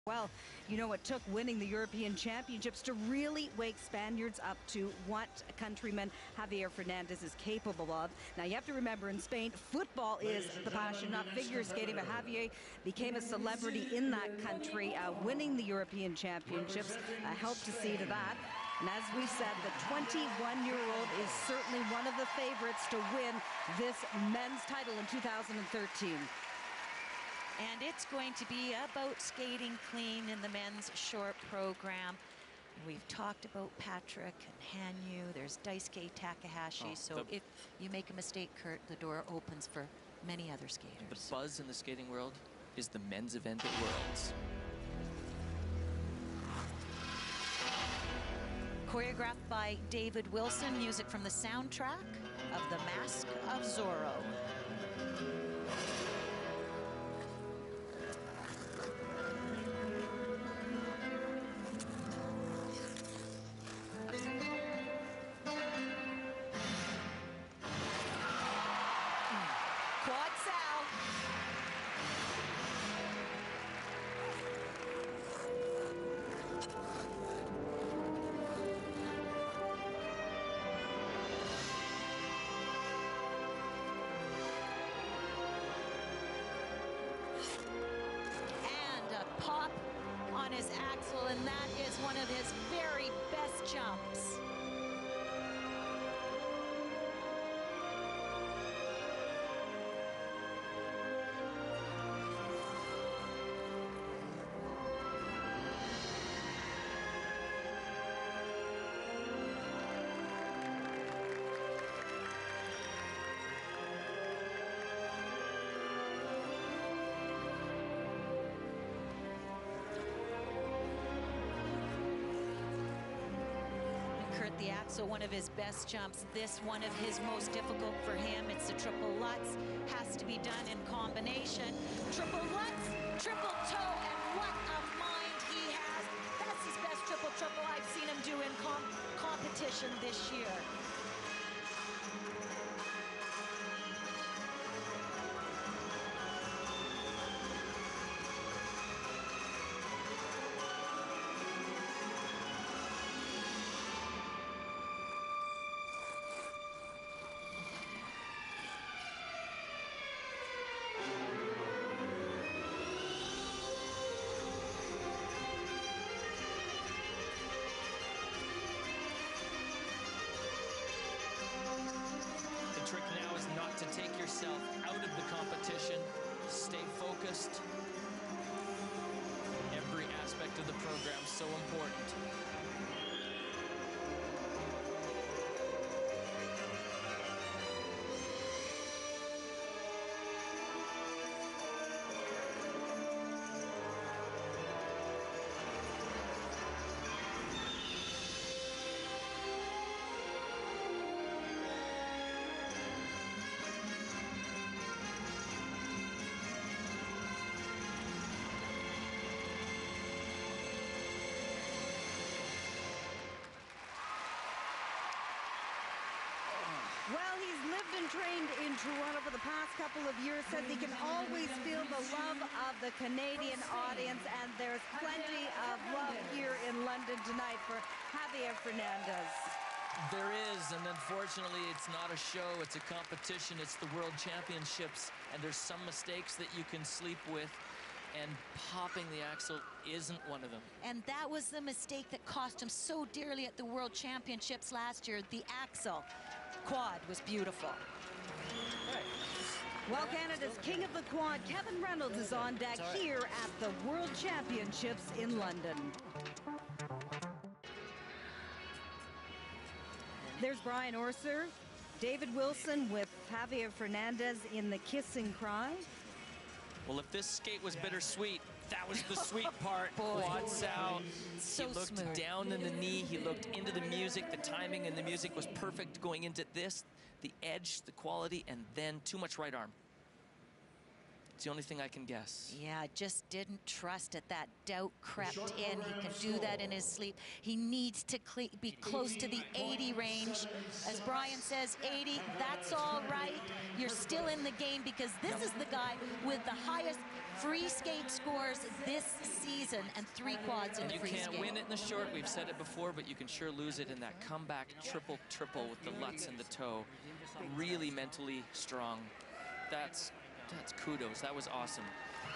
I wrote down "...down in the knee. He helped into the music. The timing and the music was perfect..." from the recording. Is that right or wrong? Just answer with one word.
wrong.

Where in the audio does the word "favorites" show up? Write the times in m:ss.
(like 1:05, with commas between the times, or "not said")
0:22.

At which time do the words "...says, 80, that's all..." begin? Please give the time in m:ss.
4:51.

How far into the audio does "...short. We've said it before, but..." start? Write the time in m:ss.
5:01.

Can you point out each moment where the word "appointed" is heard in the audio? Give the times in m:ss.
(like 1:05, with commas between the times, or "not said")
not said.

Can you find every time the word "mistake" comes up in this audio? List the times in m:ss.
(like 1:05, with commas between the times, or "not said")
0:38, 3:55, 4:01.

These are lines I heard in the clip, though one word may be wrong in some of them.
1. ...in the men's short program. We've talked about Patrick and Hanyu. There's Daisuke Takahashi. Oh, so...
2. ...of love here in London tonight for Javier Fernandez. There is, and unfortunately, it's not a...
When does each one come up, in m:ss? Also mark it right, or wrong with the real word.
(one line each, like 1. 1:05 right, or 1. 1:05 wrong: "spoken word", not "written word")
1. 0:30 right
2. 3:45 right.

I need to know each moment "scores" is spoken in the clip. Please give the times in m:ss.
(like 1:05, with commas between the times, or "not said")
4:58.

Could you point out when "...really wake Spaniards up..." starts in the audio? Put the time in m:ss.
0:02.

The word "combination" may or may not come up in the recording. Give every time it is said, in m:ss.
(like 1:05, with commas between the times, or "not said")
2:10.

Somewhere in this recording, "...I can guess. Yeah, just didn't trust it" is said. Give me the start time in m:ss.
4:41.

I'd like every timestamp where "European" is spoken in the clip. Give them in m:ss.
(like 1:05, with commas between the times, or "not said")
0:01, 0:15.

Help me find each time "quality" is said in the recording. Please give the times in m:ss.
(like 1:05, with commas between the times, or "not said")
4:37.